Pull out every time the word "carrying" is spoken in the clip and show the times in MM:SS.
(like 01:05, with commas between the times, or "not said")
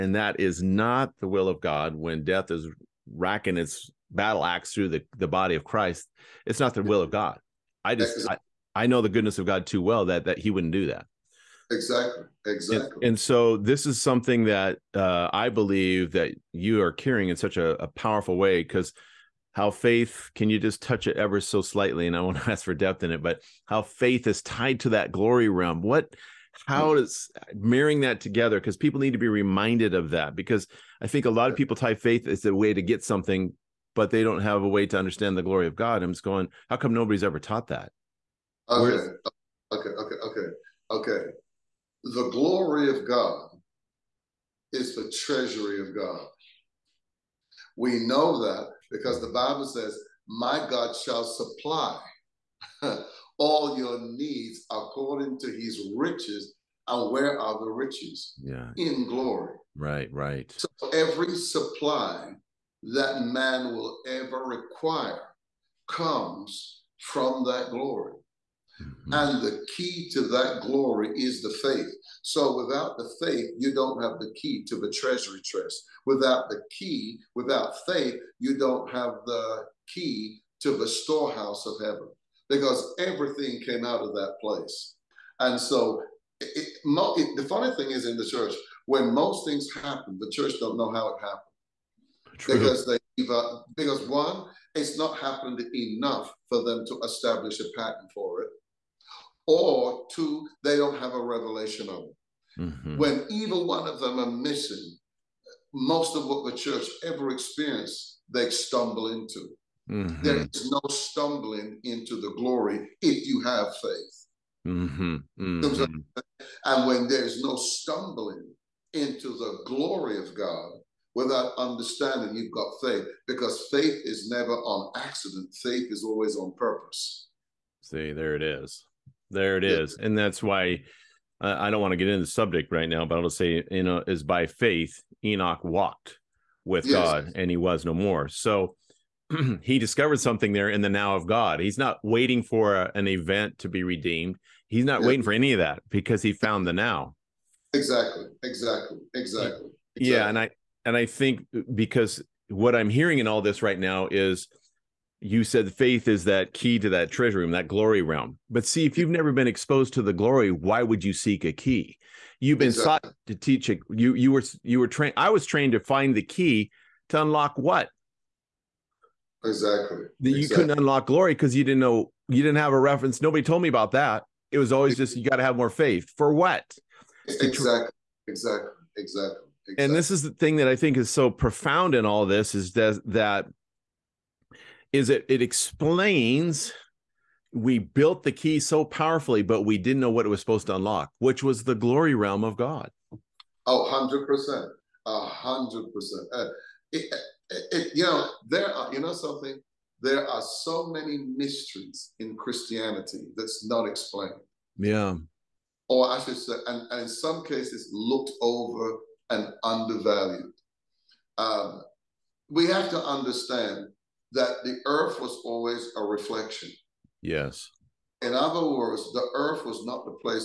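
00:16.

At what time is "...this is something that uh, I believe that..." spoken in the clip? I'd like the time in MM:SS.
00:13.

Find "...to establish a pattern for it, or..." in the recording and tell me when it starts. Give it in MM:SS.
01:36.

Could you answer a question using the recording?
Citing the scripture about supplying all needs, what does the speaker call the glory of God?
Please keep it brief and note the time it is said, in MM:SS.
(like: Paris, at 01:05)
The treasury of God, at 00:44.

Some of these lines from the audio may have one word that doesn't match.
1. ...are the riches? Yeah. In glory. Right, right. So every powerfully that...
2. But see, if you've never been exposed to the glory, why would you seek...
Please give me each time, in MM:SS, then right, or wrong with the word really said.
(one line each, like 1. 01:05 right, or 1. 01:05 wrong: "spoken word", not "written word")
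1. 00:57 wrong: "supply", not "powerfully"
2. 02:38 right.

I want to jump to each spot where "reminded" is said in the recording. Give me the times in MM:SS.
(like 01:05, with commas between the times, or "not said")
00:29.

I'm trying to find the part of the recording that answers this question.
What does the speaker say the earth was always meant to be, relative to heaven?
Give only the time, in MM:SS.
03:35.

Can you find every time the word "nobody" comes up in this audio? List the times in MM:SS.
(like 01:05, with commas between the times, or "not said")
00:36, 02:53.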